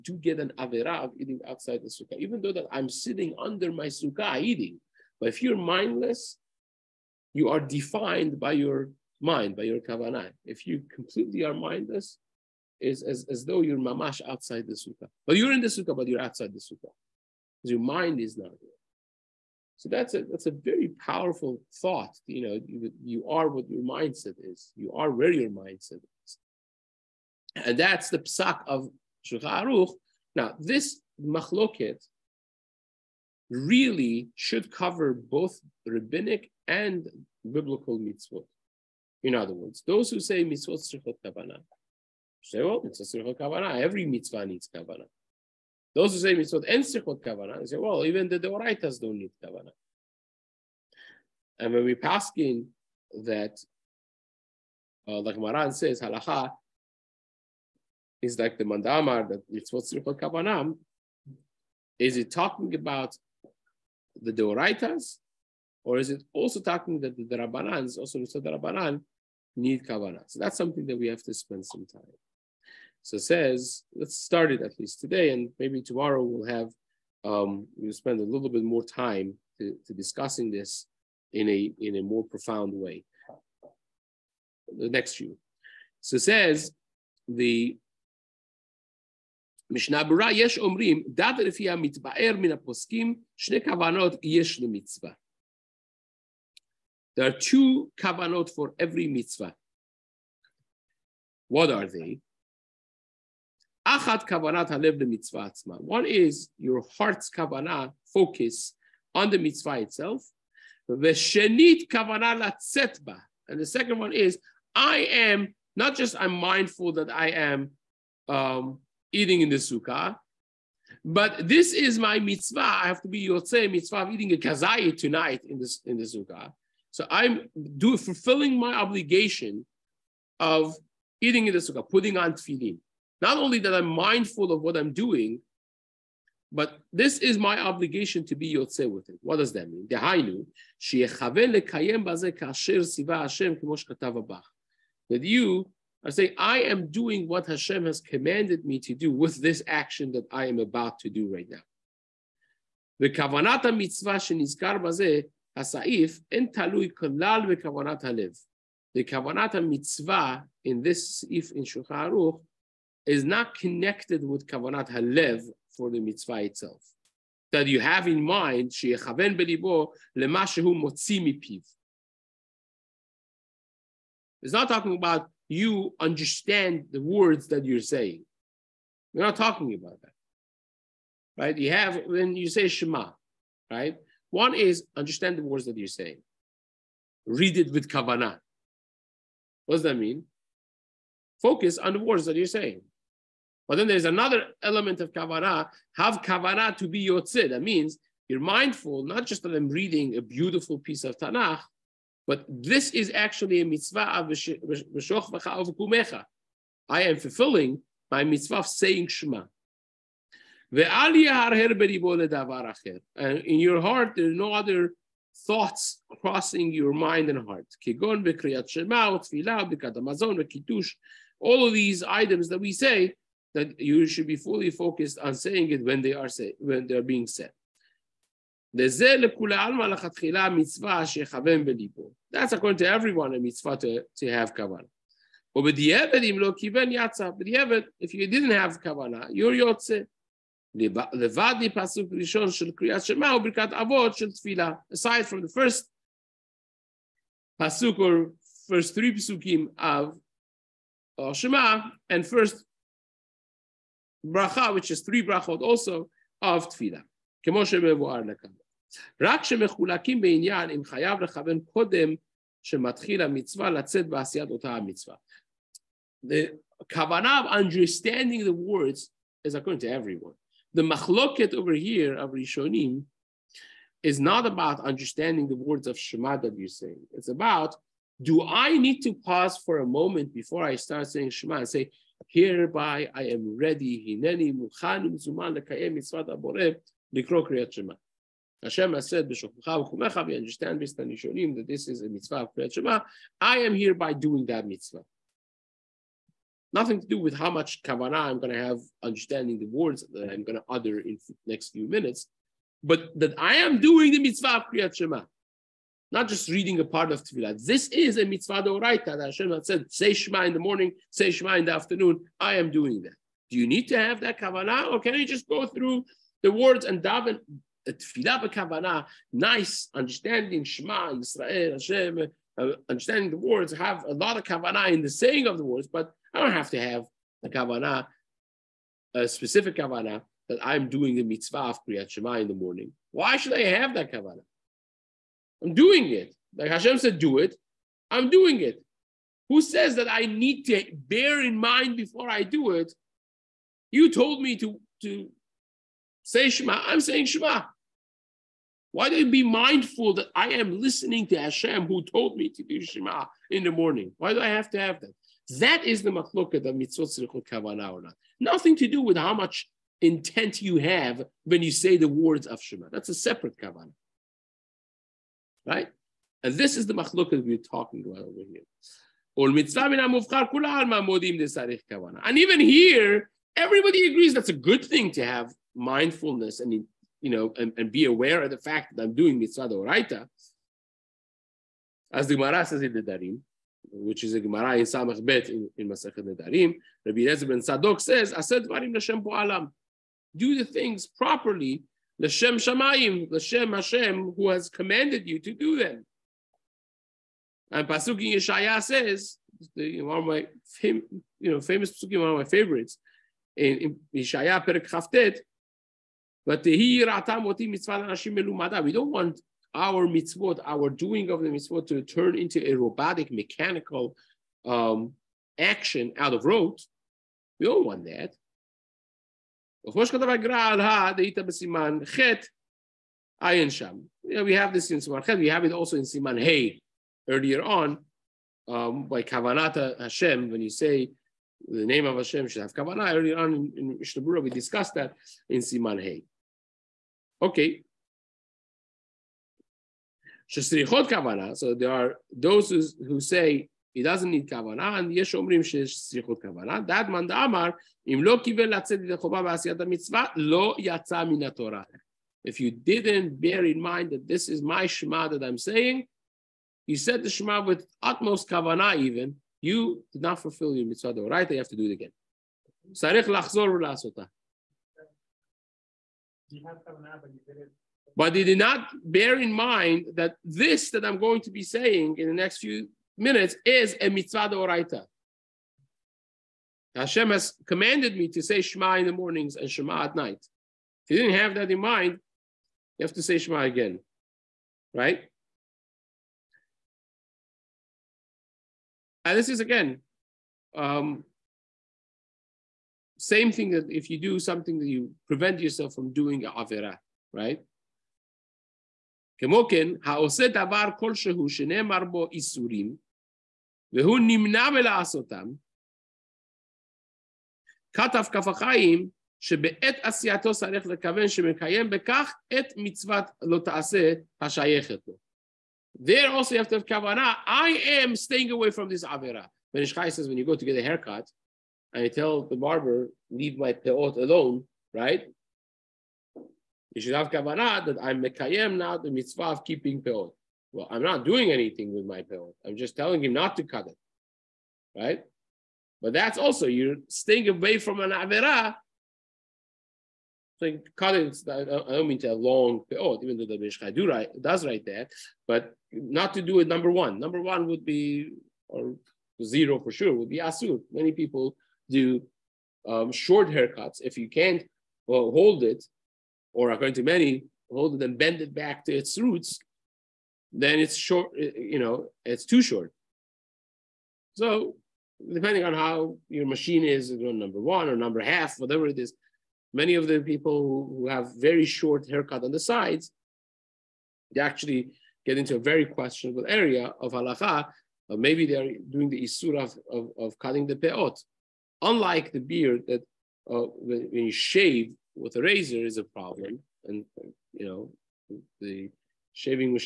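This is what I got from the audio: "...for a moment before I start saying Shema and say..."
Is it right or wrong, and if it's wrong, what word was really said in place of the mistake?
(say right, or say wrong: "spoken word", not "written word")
right.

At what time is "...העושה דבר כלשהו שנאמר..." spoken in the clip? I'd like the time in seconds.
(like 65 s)
500 s.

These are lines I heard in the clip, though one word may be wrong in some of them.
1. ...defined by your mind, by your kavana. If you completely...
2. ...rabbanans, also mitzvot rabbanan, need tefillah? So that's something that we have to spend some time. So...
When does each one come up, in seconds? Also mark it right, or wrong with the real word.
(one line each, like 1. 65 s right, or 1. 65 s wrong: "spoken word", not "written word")
1. 7 s right
2. 67 s wrong: "kavanah", not "tefillah".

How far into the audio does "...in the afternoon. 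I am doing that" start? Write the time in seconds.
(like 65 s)
311 s.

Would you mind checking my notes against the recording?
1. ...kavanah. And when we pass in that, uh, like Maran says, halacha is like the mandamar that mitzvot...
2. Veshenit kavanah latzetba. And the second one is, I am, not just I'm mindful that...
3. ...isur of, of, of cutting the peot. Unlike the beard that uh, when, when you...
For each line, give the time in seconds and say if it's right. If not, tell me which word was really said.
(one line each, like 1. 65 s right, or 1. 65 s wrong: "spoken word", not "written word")
1. 49 s right
2. 110 s right
3. 579 s right.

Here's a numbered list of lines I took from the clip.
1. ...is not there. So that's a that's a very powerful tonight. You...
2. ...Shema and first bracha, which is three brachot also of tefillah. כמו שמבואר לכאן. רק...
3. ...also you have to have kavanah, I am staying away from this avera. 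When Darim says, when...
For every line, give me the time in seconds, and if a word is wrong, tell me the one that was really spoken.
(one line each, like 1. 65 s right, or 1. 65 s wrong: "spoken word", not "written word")
1. 18 s wrong: "thought", not "tonight"
2. 251 s right
3. 516 s wrong: "Ishkai", not "Darim".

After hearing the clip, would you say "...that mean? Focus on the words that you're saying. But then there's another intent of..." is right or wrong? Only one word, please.
wrong.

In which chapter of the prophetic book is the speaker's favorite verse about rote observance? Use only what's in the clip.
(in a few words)
Chaf Tet.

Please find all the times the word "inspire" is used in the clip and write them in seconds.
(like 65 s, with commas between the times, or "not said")
not said.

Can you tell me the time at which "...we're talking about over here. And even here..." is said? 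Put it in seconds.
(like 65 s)
367 s.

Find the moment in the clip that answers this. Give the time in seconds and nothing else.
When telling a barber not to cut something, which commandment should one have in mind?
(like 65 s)
529 s.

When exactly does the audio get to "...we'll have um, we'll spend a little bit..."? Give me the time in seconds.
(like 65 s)
76 s.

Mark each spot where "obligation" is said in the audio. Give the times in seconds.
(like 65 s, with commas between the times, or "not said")
128 s, 137 s.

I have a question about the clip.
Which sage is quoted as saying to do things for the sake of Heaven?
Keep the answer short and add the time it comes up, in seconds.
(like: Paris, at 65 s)
Rabbi Ezra ben Sadok, at 387 s.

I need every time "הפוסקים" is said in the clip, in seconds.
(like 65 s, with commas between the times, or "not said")
93 s.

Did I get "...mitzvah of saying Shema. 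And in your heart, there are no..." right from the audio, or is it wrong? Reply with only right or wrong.
right.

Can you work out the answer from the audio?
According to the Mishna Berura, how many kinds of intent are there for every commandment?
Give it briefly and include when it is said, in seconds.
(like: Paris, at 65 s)
2, at 97 s.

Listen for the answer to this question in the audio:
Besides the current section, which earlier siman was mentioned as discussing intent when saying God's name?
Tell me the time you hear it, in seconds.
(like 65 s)
435 s.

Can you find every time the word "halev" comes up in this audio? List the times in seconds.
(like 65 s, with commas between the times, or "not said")
104 s, 158 s, 164 s.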